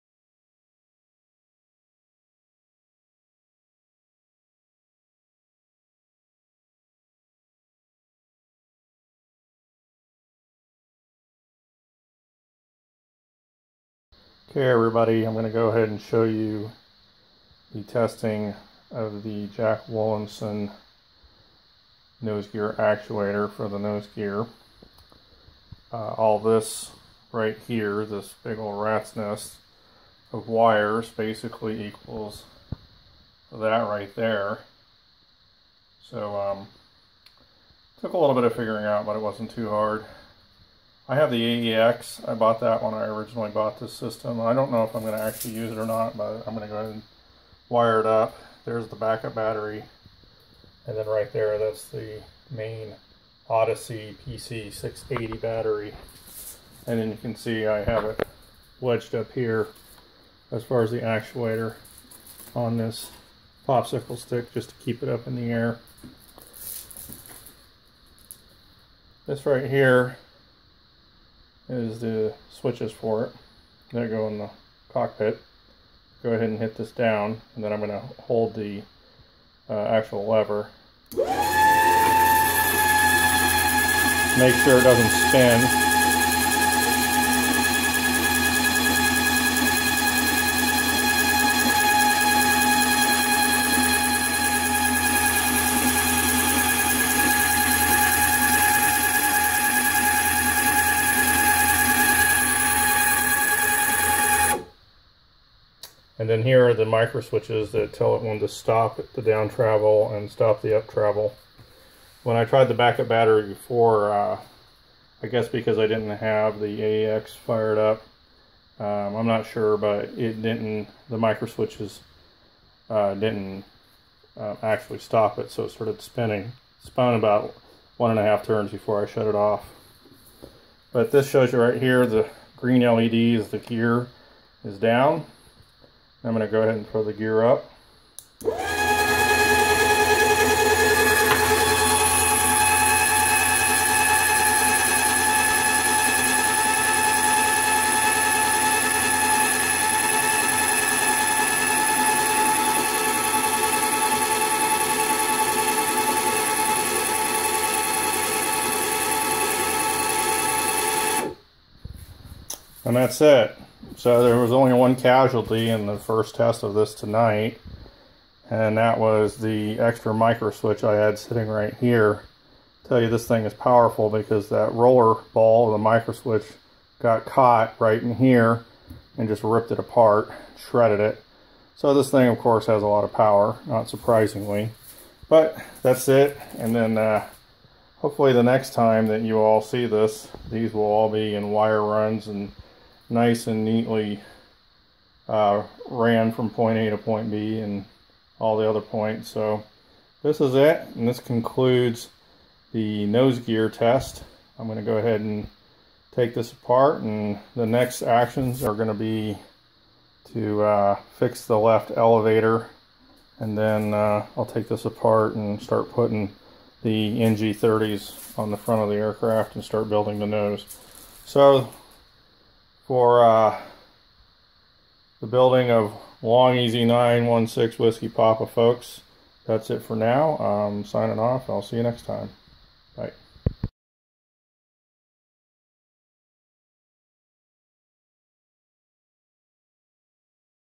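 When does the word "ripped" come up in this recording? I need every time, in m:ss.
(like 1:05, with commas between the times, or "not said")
2:59.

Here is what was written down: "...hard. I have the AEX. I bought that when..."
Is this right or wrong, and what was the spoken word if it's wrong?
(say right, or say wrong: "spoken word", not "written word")
right.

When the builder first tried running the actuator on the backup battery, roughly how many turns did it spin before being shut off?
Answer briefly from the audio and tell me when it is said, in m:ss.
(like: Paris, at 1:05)
1.5 turns, at 2:07.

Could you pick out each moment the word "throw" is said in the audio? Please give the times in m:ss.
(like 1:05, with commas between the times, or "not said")
2:16.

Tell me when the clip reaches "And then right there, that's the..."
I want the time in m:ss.
0:50.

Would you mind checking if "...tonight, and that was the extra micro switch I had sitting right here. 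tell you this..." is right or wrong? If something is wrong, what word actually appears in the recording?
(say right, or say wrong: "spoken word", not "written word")
right.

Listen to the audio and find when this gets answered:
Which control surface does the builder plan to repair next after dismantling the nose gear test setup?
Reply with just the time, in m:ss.
3:31.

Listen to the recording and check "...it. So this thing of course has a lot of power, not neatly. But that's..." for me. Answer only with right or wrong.
wrong.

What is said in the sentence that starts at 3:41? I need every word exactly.
So for uh, the building of Long-EZ 916 Whiskey Papa, folks.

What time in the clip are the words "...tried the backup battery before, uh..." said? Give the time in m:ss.
1:52.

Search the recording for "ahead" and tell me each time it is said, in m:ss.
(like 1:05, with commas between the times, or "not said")
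0:15, 0:46, 1:16, 2:16, 3:24.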